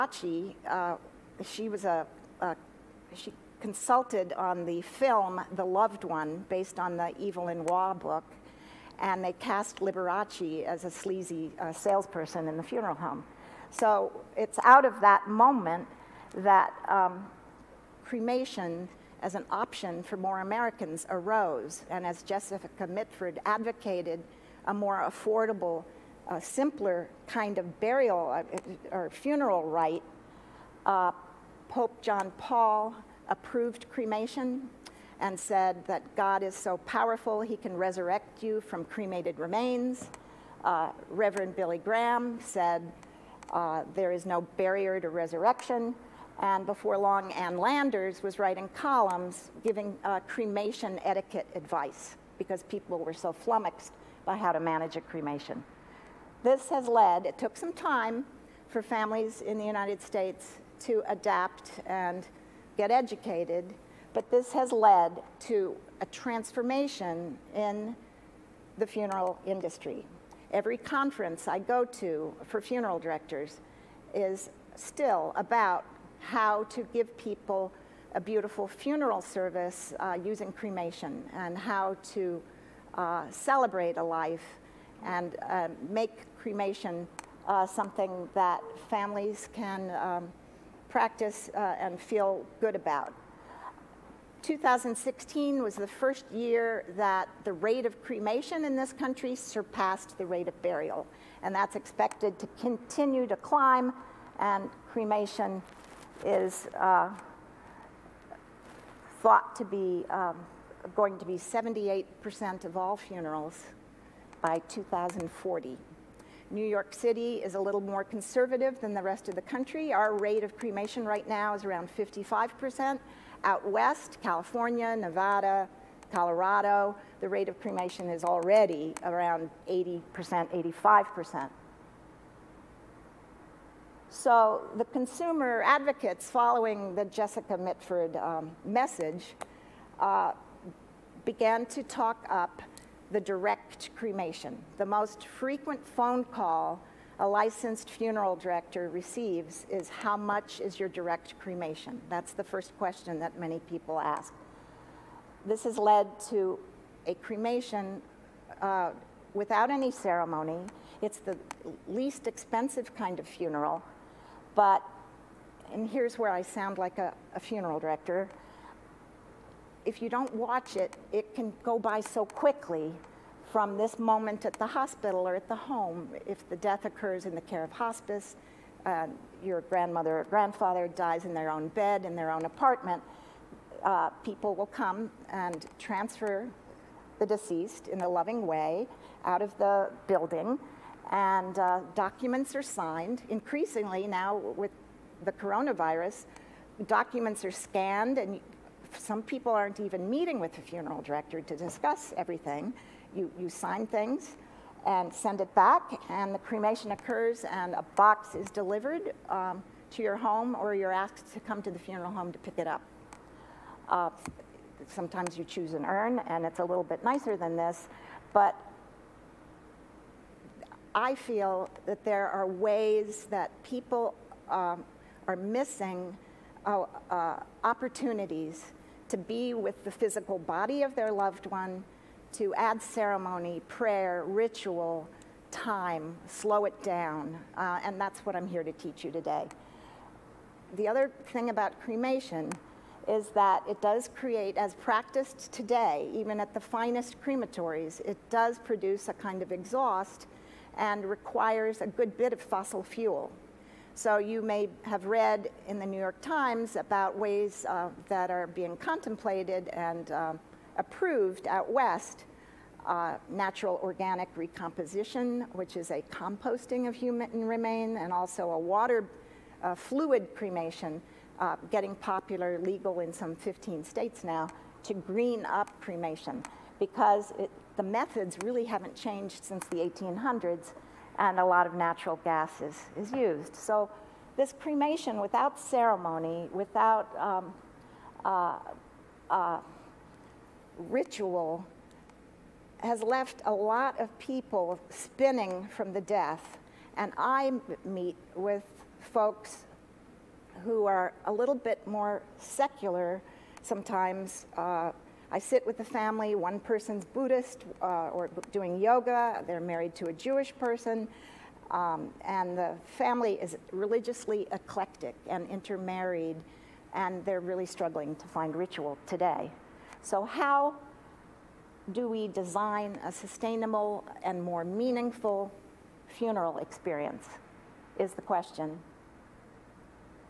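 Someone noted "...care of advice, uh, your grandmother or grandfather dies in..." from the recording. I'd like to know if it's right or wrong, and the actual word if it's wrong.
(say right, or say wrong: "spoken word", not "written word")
wrong: "hospice", not "advice".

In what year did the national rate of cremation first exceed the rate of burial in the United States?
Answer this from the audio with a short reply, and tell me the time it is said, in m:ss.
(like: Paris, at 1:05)
2016, at 1:34.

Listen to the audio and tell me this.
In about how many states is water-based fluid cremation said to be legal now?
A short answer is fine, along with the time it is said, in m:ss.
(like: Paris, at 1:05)
15, at 4:33.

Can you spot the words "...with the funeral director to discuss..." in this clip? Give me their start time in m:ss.
3:20.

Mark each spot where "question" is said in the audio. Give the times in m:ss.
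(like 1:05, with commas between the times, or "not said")
2:32, 5:28.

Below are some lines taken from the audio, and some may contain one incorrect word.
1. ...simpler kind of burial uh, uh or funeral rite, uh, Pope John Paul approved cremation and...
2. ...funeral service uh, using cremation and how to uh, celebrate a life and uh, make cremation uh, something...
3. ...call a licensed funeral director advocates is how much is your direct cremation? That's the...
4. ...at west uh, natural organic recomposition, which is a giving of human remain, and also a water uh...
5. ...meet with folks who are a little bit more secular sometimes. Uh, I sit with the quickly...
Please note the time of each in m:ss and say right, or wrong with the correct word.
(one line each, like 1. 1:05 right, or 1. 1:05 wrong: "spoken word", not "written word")
1. 0:26 right
2. 1:18 right
3. 2:26 wrong: "receives", not "advocates"
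4. 4:21 wrong: "composting", not "giving"
5. 4:57 wrong: "family", not "quickly".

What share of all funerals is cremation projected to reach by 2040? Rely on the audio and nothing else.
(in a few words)
78%.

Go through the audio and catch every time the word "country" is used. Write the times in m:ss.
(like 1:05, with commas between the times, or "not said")
1:38, 1:59.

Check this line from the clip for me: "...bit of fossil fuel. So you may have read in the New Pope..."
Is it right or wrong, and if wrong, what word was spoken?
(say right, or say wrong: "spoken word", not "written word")
wrong: "York", not "Pope".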